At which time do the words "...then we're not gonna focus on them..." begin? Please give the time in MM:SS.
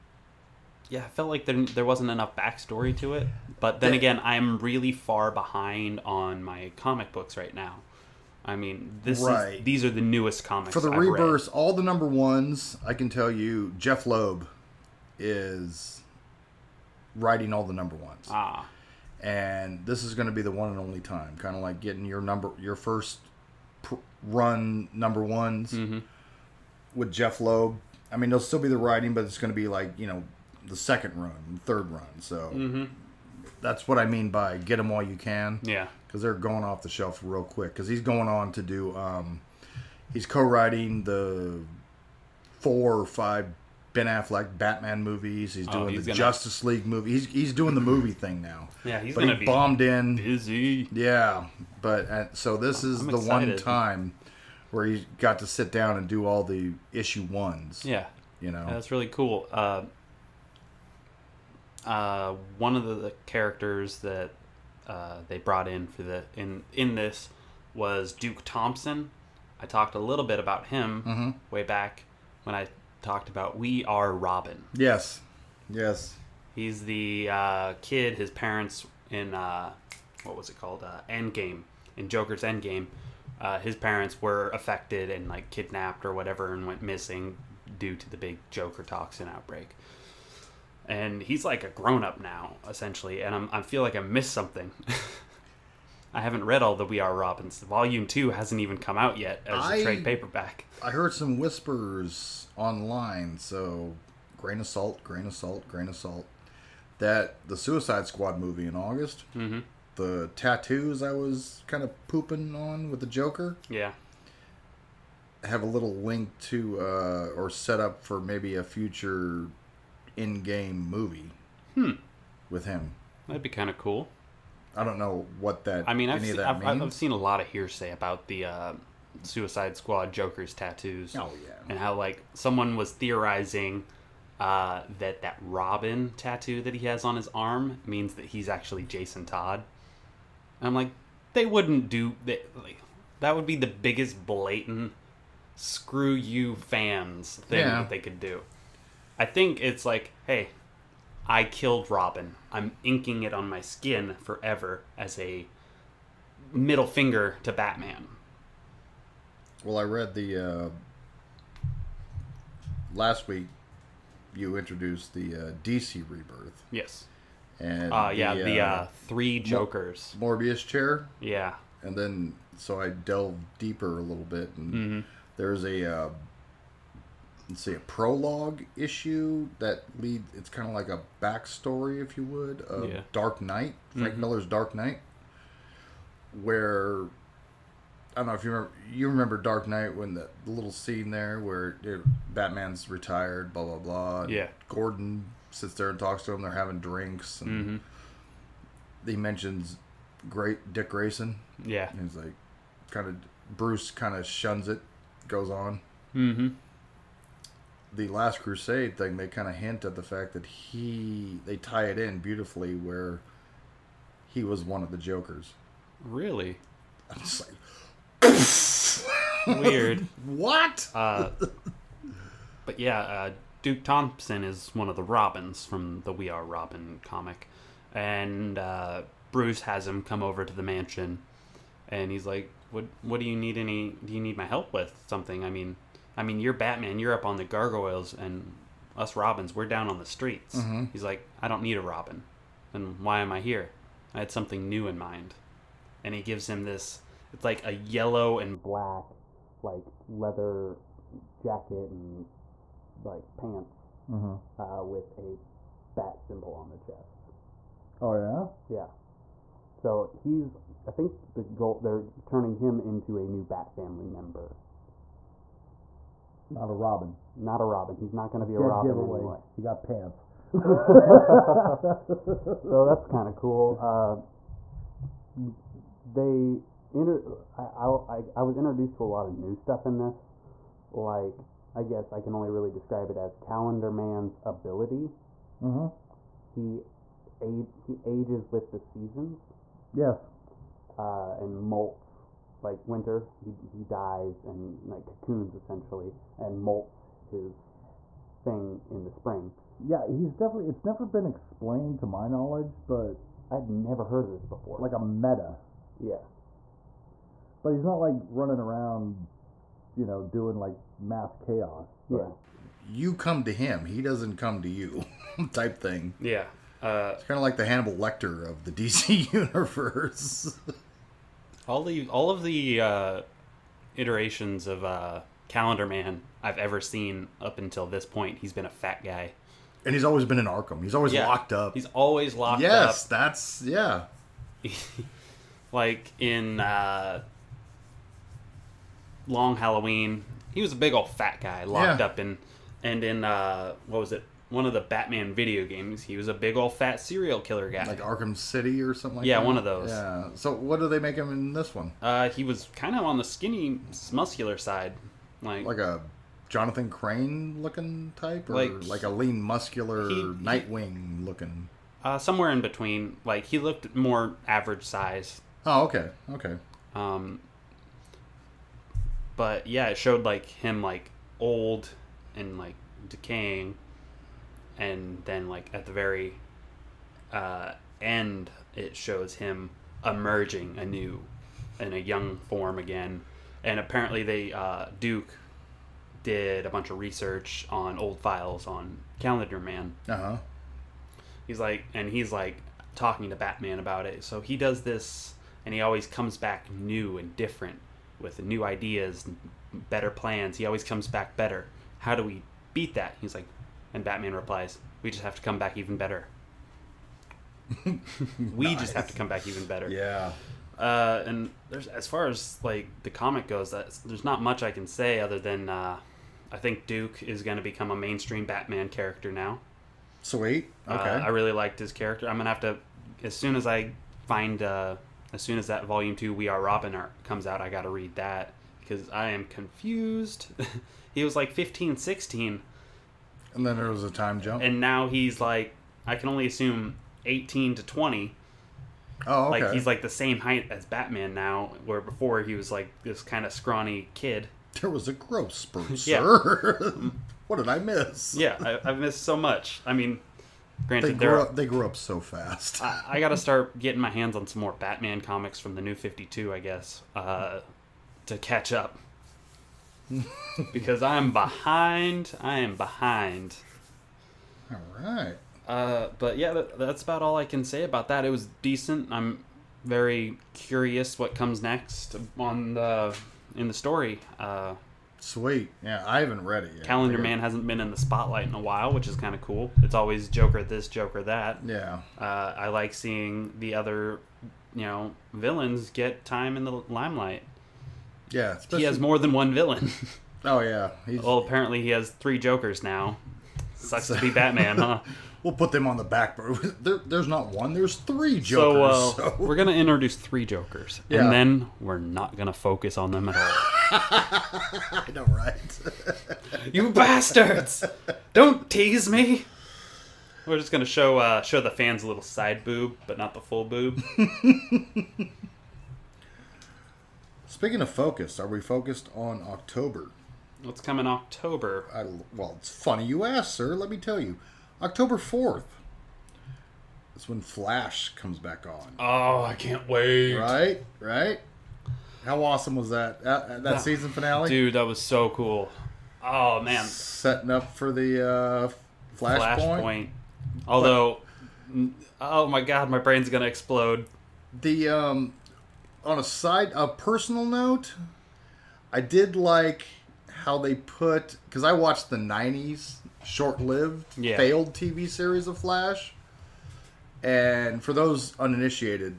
08:21.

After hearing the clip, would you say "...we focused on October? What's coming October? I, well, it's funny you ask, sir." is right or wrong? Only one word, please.
right.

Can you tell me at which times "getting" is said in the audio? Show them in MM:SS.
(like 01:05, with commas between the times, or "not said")
00:21, 07:33.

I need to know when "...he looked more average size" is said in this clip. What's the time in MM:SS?
06:03.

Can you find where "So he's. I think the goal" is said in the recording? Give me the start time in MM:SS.
04:19.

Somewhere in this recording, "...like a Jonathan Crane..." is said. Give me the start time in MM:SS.
05:55.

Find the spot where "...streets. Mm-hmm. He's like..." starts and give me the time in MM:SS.
04:00.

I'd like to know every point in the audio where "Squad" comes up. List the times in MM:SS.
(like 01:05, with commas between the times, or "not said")
01:48, 02:09.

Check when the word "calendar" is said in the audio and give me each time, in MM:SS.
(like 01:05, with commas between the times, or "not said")
04:43, 05:25, 06:29, 07:56.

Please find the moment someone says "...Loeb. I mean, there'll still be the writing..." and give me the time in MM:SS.
00:27.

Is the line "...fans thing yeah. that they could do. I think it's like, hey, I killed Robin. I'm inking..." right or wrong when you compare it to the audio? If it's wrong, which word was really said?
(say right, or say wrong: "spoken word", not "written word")
right.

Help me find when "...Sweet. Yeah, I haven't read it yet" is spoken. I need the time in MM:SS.
07:55.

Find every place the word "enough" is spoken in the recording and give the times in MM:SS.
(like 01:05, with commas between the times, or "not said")
00:02.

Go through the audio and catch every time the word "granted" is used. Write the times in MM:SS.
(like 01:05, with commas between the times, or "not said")
07:30.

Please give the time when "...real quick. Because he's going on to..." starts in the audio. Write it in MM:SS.
00:37.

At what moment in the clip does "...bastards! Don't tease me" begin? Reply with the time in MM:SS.
08:26.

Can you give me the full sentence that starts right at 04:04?
I had something new in mind.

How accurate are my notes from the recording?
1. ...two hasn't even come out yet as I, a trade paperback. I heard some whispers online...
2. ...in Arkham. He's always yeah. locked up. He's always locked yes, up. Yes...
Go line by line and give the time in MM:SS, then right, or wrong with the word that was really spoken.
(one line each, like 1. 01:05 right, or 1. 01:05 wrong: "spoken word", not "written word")
1. 01:38 right
2. 05:30 right.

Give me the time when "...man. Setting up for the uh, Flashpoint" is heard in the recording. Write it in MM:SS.
08:56.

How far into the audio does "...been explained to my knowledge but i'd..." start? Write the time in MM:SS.
05:01.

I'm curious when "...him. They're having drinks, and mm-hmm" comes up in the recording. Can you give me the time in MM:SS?
03:16.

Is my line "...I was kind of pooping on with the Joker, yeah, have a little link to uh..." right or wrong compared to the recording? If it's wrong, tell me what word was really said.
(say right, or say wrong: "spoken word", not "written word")
right.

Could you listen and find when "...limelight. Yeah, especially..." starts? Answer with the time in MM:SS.
08:06.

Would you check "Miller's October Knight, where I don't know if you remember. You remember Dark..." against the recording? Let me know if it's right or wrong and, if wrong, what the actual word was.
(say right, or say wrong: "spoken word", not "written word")
wrong: "Dark", not "October".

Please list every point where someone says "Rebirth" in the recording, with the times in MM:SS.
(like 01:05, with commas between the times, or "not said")
00:10, 02:46.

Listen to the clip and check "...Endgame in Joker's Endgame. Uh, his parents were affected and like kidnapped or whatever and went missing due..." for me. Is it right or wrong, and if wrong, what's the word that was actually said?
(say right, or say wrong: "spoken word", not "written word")
right.